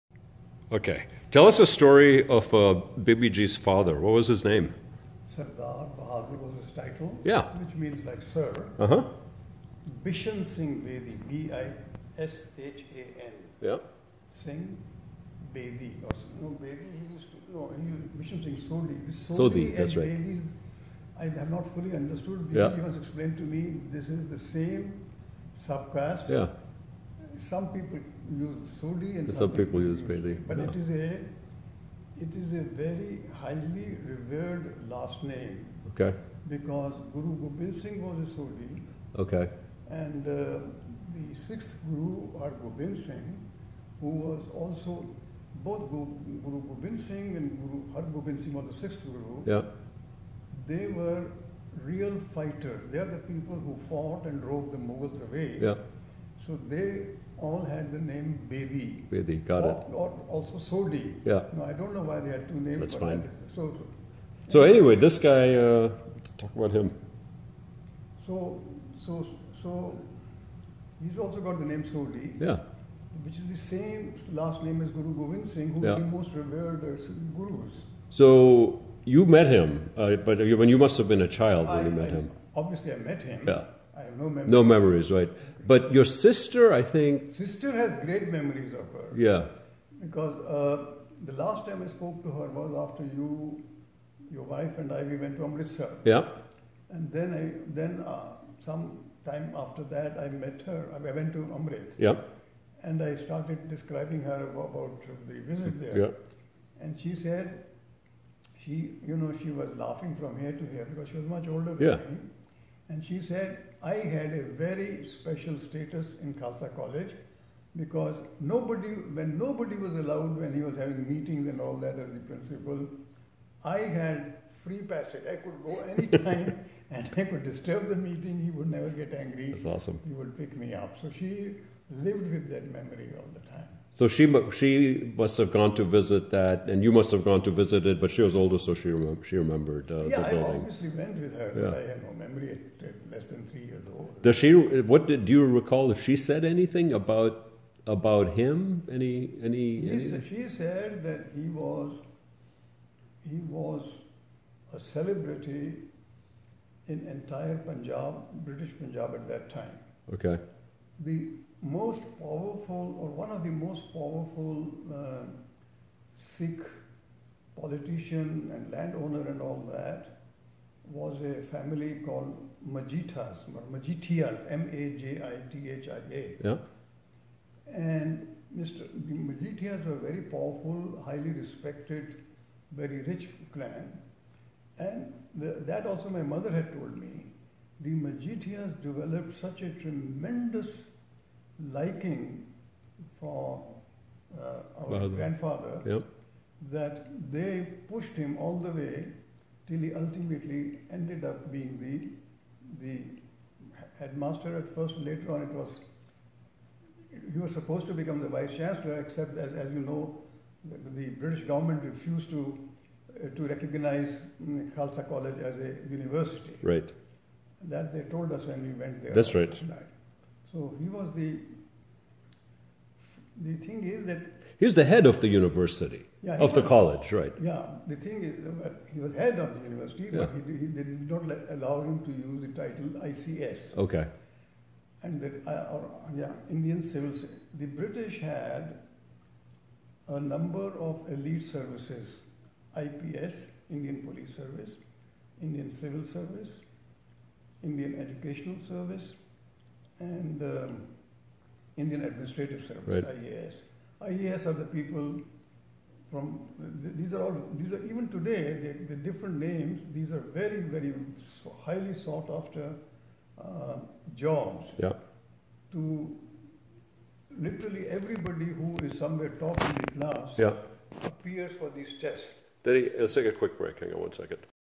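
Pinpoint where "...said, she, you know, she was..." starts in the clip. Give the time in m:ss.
1:47.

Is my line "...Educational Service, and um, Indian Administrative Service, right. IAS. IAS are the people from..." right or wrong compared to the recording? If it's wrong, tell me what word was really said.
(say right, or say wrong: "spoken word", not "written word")
right.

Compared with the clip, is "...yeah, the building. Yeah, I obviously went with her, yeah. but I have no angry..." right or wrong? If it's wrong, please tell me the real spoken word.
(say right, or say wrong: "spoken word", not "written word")
wrong: "memory", not "angry".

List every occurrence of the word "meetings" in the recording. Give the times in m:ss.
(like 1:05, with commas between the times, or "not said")
2:01, 2:07.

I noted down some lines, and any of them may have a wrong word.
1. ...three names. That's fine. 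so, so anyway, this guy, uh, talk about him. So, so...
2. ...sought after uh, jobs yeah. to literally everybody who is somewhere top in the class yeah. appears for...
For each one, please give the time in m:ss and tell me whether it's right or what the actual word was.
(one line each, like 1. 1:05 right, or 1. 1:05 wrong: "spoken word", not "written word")
1. 1:02 wrong: "two", not "three"
2. 4:21 right.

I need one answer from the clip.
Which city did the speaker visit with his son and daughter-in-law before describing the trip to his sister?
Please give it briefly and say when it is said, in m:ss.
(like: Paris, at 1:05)
Amritsar, at 1:35.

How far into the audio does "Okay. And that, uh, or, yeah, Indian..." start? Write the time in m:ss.
3:53.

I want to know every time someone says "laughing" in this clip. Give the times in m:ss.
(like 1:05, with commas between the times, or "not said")
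1:49.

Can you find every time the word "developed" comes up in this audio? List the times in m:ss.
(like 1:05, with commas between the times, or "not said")
3:08.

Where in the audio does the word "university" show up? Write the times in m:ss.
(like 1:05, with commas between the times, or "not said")
3:35, 3:45, 3:49.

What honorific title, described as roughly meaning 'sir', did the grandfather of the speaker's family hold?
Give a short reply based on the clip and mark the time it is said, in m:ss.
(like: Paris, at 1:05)
Sardar Bahadur, at 0:05.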